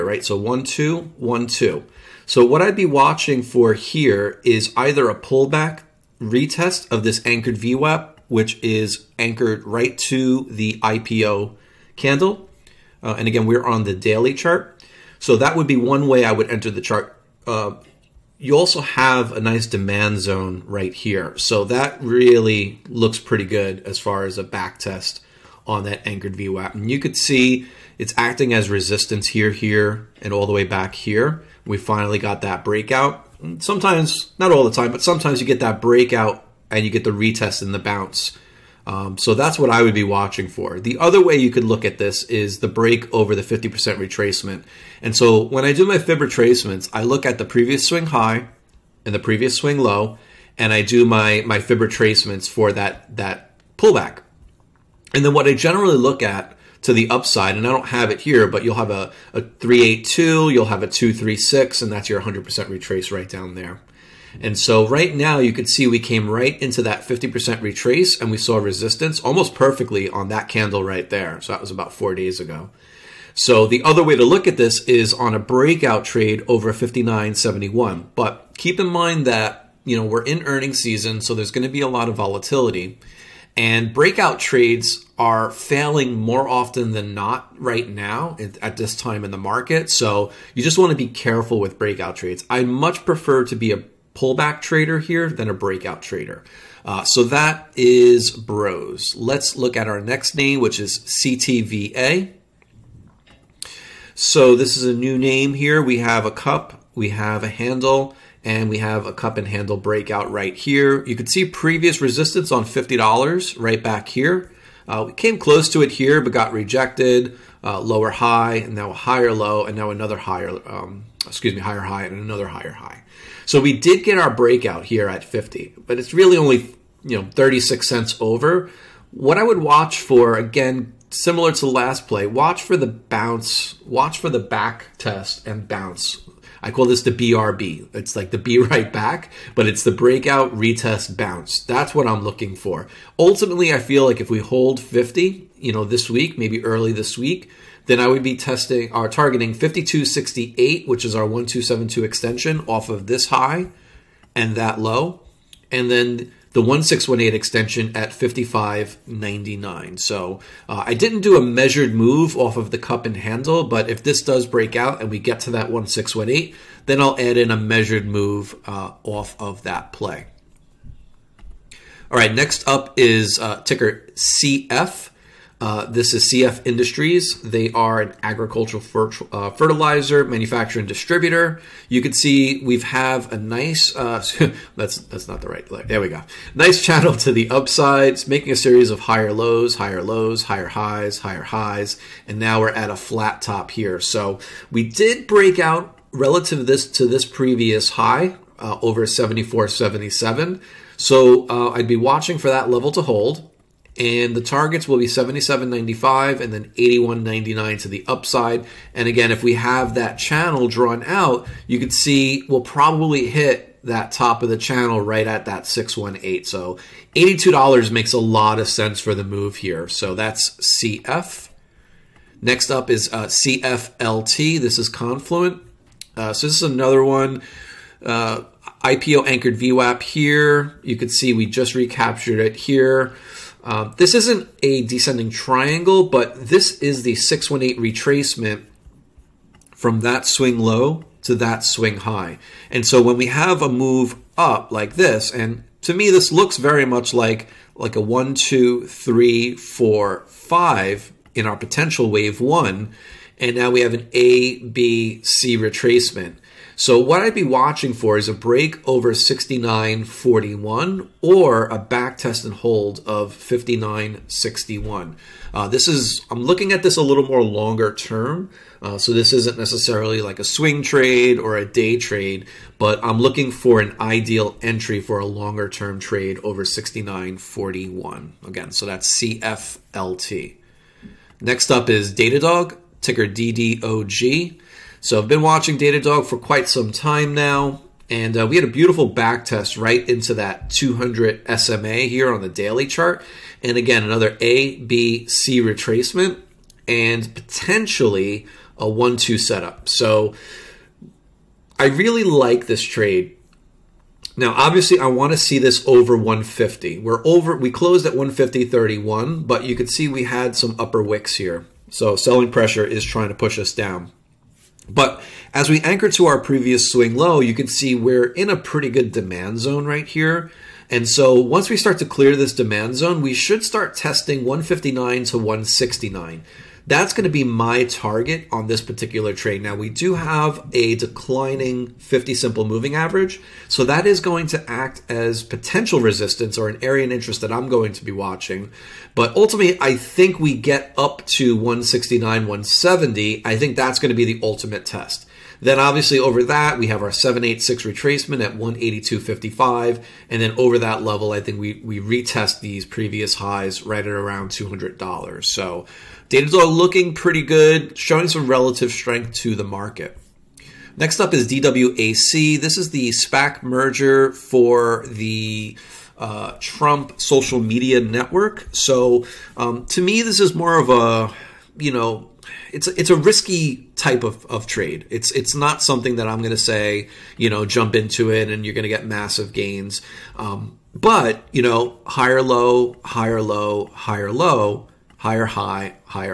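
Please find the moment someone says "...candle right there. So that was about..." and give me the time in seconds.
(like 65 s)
70 s.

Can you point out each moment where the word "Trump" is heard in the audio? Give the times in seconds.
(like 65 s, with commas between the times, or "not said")
366 s.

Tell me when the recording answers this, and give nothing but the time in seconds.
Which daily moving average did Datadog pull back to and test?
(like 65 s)
290 s.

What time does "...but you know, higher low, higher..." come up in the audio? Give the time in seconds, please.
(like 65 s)
380 s.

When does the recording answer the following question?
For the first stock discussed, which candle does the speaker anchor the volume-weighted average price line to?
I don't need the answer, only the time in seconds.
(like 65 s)
10 s.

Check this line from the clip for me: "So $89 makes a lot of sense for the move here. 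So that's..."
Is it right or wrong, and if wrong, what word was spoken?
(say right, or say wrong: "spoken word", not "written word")
wrong: "82", not "89".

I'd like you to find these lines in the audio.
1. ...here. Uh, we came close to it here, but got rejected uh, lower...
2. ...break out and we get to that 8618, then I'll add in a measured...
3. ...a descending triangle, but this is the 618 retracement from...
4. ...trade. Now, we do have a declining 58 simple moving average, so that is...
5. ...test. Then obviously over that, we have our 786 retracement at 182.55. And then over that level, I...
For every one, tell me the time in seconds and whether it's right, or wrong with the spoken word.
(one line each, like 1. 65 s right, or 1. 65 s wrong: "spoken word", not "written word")
1. 114 s right
2. 164 s wrong: "1618", not "8618"
3. 234 s right
4. 329 s wrong: "50", not "58"
5. 344 s right.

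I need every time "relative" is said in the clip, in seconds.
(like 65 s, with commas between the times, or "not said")
196 s, 358 s.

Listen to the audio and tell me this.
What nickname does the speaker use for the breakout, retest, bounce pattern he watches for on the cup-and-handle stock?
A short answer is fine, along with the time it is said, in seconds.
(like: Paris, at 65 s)
BRB, at 137 s.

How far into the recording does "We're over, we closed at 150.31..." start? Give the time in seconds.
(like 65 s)
306 s.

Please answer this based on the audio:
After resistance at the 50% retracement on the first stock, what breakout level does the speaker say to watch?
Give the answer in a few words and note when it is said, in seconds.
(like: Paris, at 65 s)
59.71, at 76 s.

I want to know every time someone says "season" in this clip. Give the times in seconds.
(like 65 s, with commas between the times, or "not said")
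80 s.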